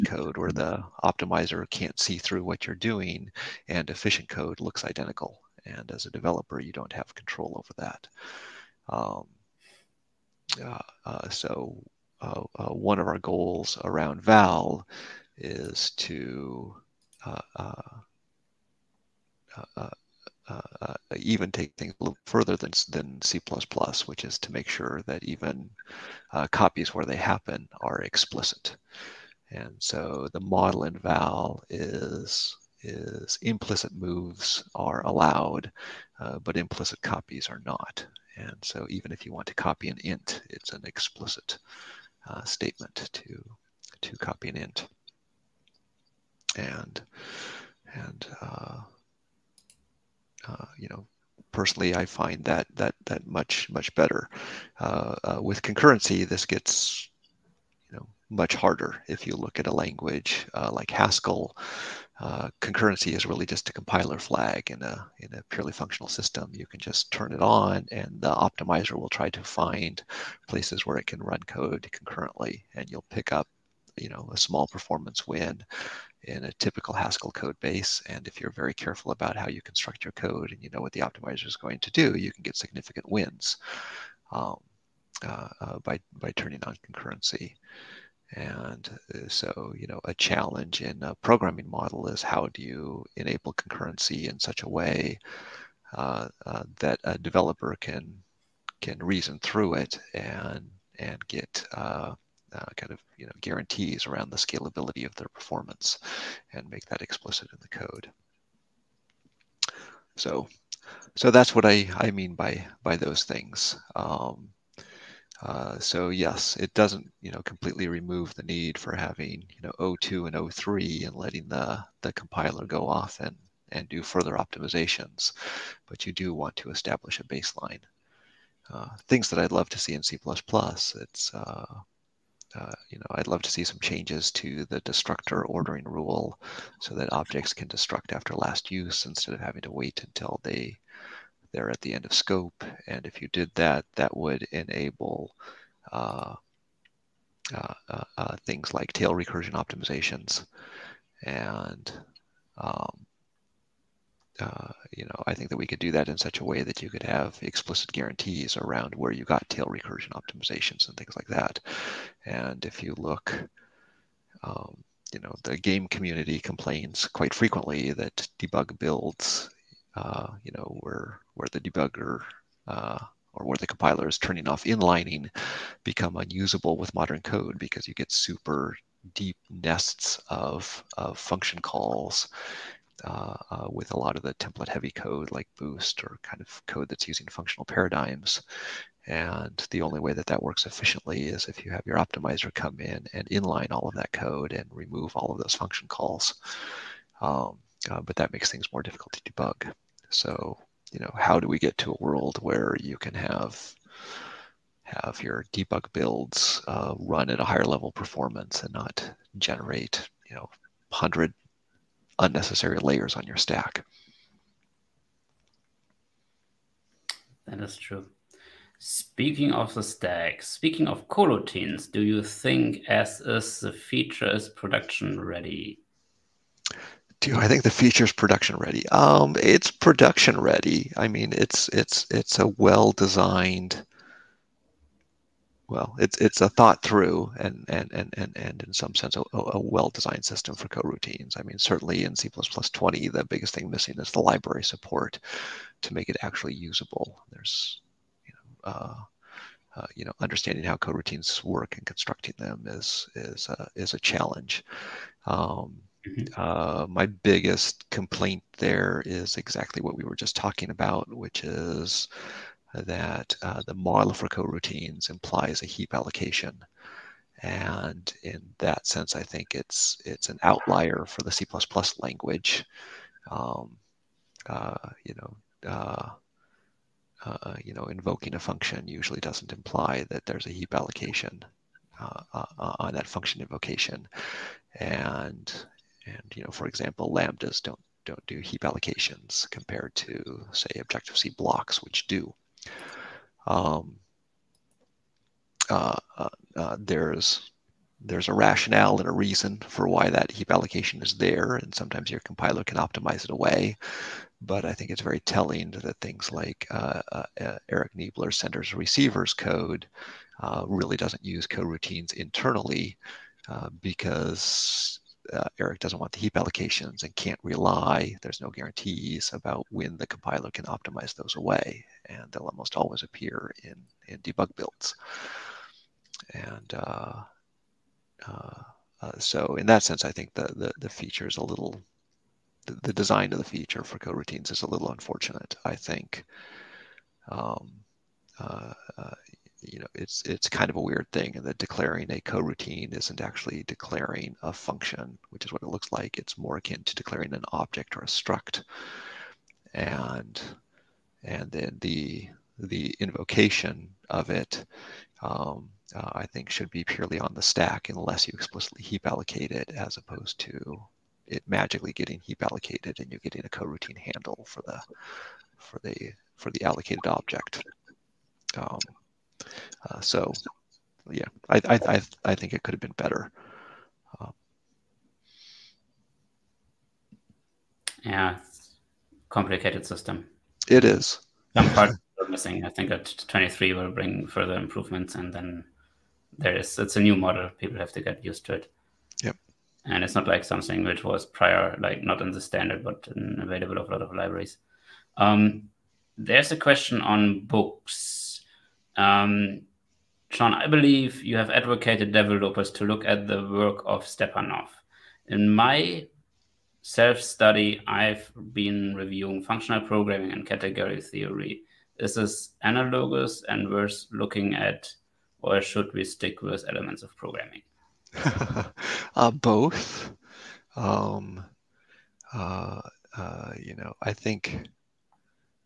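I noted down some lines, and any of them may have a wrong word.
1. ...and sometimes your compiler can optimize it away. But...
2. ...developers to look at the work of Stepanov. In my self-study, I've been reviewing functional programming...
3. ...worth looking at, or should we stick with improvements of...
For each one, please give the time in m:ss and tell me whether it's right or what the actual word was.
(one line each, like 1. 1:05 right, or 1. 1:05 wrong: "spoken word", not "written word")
1. 5:01 right
2. 6:42 right
3. 6:53 wrong: "elements", not "improvements".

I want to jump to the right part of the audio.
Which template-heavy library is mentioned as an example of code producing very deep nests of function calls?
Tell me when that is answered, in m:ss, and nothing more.
3:05.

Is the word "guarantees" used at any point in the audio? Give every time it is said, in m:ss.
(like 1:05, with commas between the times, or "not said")
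1:43, 2:37, 5:18.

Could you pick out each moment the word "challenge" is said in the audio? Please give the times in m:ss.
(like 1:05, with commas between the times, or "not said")
1:30, 4:13.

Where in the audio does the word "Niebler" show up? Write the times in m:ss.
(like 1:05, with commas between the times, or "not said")
5:07.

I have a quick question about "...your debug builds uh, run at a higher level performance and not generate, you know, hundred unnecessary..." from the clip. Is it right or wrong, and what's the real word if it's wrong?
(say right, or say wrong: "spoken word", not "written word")
right.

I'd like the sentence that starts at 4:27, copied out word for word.
And in that sense, I think it's it's an outlier for the C++ language.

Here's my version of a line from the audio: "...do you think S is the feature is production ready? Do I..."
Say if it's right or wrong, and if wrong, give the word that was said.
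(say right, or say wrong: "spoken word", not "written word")
right.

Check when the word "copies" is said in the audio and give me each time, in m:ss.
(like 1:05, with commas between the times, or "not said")
0:26, 0:37.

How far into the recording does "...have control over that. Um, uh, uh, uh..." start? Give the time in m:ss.
0:06.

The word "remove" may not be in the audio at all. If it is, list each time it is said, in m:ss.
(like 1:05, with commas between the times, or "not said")
1:57, 3:14.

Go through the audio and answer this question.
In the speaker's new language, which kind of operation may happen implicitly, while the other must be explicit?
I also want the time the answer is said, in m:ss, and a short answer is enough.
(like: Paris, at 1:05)
Moves, at 0:33.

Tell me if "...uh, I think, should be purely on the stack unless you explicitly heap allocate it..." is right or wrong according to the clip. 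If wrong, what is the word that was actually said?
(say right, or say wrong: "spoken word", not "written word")
right.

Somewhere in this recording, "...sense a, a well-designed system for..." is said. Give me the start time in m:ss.
3:58.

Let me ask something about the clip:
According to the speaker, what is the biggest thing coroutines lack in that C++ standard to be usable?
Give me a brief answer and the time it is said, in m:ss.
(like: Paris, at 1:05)
Library support, at 4:04.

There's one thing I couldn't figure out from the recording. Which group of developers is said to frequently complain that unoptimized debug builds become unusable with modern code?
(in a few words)
The game community.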